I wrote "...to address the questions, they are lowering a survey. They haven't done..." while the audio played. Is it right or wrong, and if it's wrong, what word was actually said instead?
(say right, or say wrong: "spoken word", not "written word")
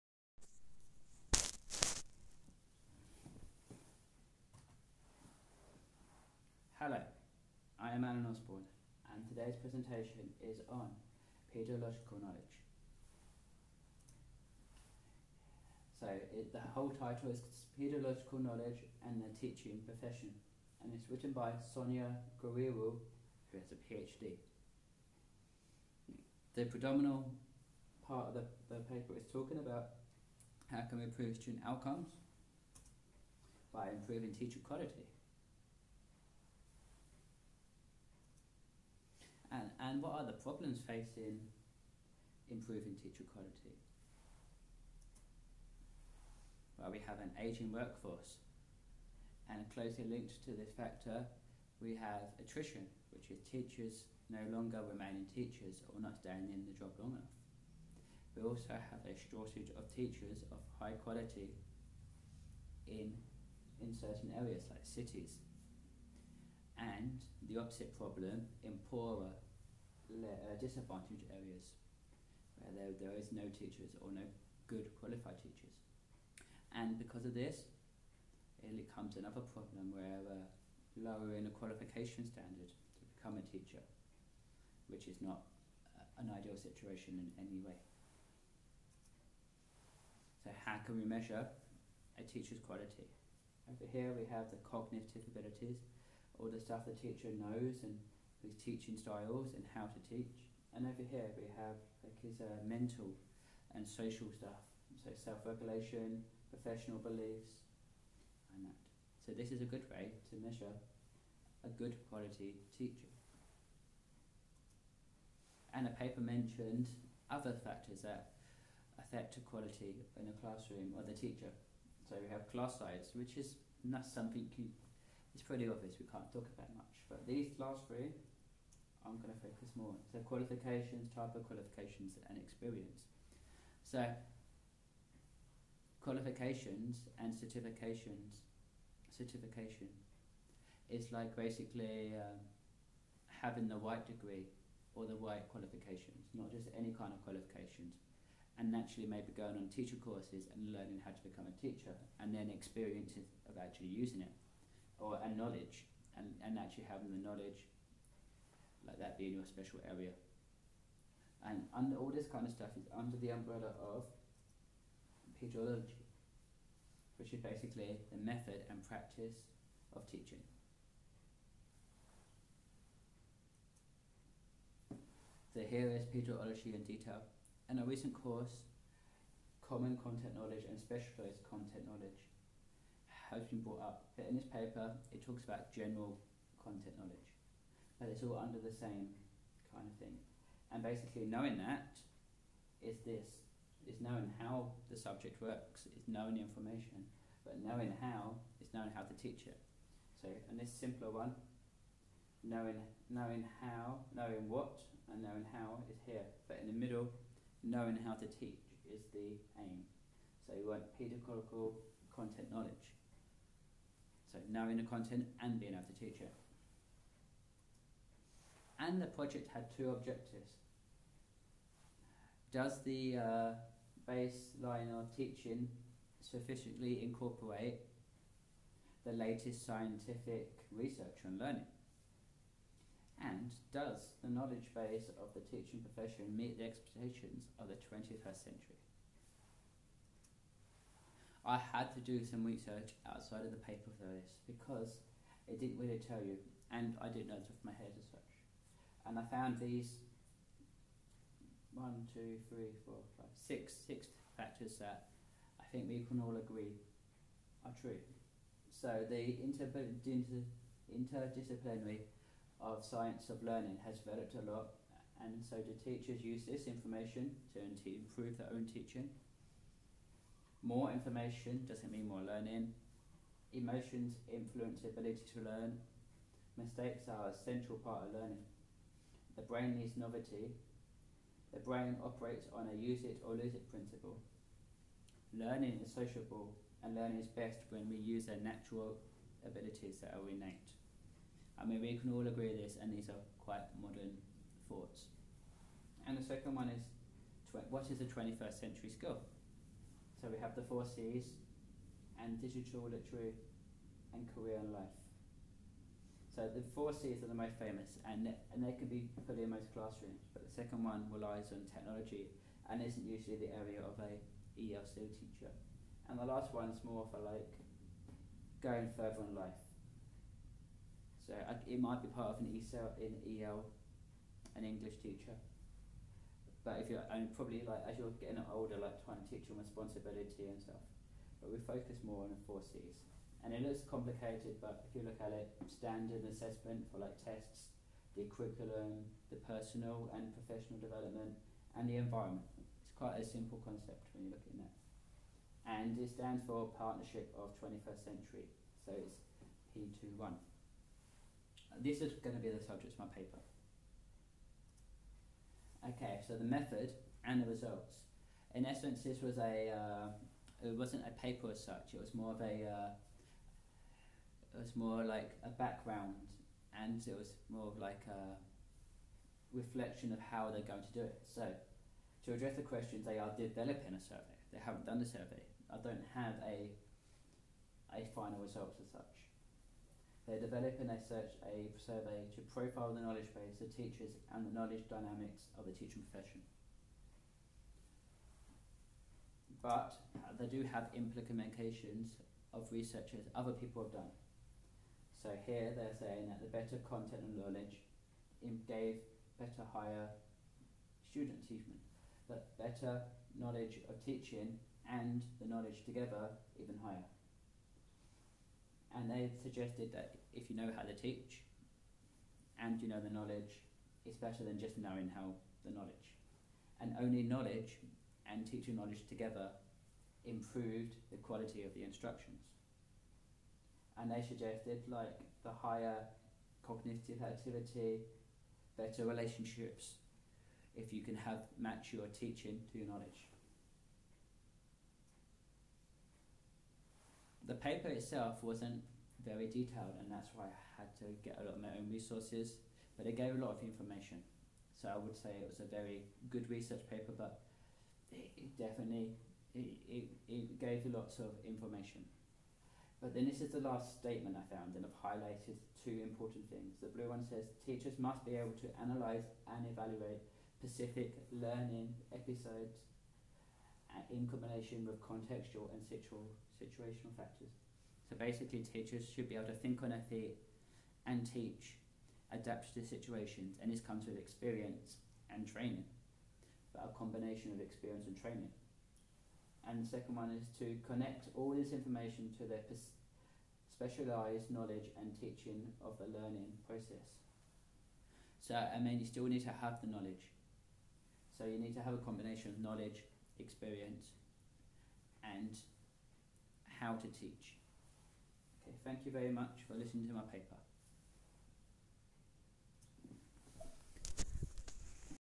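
wrong: "developing", not "lowering".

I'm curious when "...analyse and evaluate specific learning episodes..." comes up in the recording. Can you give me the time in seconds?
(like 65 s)
458 s.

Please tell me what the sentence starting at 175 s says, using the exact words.
So here is pedagogy in detail.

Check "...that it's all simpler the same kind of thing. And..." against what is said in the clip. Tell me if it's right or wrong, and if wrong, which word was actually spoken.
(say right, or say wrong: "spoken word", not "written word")
wrong: "under", not "simpler".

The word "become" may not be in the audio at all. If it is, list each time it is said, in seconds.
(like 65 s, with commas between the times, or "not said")
83 s, 151 s.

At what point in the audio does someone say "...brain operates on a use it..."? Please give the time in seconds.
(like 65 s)
281 s.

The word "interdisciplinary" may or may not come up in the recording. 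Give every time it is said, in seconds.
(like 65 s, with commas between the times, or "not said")
259 s.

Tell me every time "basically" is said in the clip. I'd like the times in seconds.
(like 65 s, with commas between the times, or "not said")
141 s, 167 s, 190 s, 468 s.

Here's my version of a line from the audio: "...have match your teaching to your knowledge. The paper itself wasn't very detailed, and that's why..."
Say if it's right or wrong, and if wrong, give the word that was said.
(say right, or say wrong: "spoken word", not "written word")
right.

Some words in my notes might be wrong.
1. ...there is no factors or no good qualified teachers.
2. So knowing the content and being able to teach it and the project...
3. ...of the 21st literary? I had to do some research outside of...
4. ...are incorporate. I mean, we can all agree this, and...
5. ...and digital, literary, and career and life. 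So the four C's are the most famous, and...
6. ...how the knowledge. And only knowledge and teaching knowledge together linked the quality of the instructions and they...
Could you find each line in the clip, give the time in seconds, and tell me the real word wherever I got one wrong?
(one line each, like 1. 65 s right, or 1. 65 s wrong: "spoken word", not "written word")
1. 72 s wrong: "teachers", not "factors"
2. 214 s right
3. 237 s wrong: "century", not "literary"
4. 290 s wrong: "innate", not "incorporate"
5. 302 s right
6. 415 s wrong: "improved", not "linked".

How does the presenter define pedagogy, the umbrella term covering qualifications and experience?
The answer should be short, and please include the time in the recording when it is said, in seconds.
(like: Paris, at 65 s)
method and practice of teaching, at 168 s.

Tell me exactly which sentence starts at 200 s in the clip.
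So, and this simpler one, knowing knowing how, knowing what, and knowing how is here.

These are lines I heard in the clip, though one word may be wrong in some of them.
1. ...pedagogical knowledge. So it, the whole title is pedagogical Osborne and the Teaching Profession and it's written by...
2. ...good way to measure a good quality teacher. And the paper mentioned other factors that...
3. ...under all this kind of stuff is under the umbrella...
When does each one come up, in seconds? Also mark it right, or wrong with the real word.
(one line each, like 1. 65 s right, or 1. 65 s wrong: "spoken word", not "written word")
1. 11 s wrong: "Knowledge", not "Osborne"
2. 109 s right
3. 161 s right.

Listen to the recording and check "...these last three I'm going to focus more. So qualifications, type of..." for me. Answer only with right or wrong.
right.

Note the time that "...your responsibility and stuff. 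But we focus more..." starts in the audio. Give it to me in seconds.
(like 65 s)
329 s.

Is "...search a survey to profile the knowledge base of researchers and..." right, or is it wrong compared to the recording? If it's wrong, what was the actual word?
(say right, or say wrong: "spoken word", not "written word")
wrong: "teachers", not "researchers".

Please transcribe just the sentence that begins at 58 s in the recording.
We also have a shortage of teachers of high quality in, in certain areas like cities.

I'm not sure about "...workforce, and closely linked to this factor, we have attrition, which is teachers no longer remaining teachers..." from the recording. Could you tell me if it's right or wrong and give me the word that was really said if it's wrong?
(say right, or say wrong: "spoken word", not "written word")
right.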